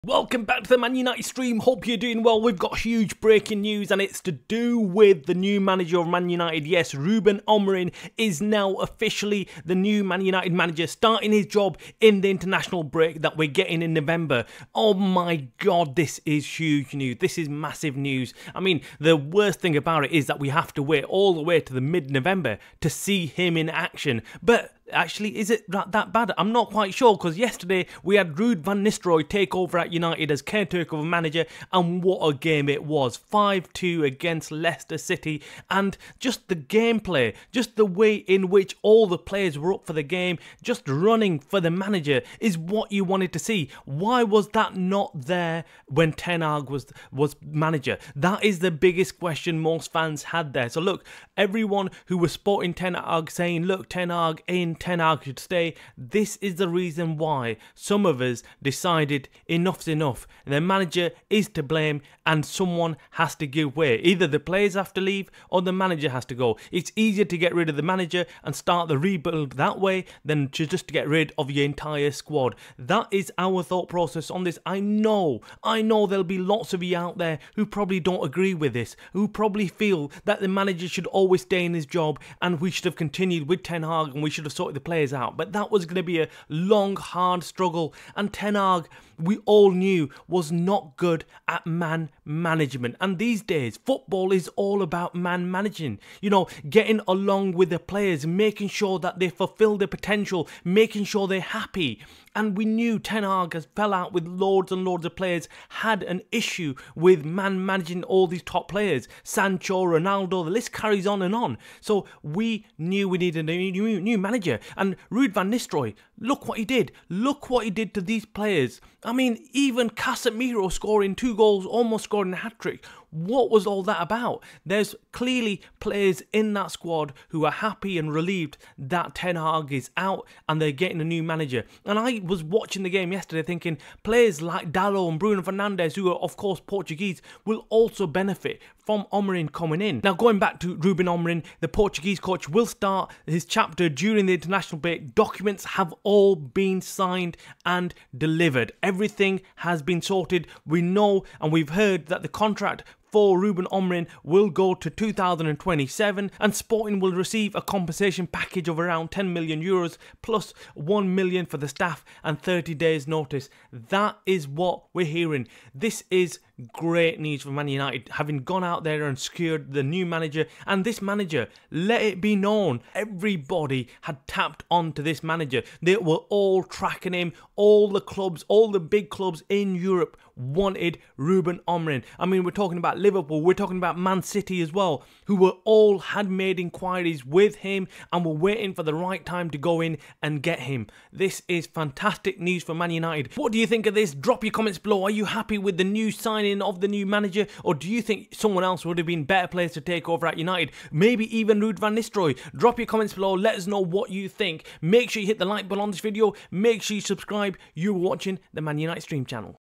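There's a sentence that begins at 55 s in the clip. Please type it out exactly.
This is the reason why some of us decided enough's enough.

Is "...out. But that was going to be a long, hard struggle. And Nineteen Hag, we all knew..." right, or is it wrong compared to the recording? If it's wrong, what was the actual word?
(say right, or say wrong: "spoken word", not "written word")
wrong: "Ten", not "Nineteen".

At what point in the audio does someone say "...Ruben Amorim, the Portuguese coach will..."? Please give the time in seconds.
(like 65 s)
140 s.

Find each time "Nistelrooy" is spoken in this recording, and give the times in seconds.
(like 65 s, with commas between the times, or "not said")
28 s, 115 s, 201 s.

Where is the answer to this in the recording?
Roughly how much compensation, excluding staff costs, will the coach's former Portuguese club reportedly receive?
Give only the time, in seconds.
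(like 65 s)
159 s.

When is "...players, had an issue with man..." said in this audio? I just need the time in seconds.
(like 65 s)
105 s.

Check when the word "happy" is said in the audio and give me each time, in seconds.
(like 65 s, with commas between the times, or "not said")
101 s, 127 s, 195 s.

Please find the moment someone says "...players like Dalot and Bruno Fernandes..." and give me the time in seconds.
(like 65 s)
134 s.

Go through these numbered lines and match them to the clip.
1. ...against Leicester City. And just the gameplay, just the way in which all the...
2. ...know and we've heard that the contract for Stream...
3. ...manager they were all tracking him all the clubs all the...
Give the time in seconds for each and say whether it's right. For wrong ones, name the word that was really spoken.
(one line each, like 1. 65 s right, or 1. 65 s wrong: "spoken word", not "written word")
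1. 34 s right
2. 150 s wrong: "Ruben", not "Stream"
3. 175 s right.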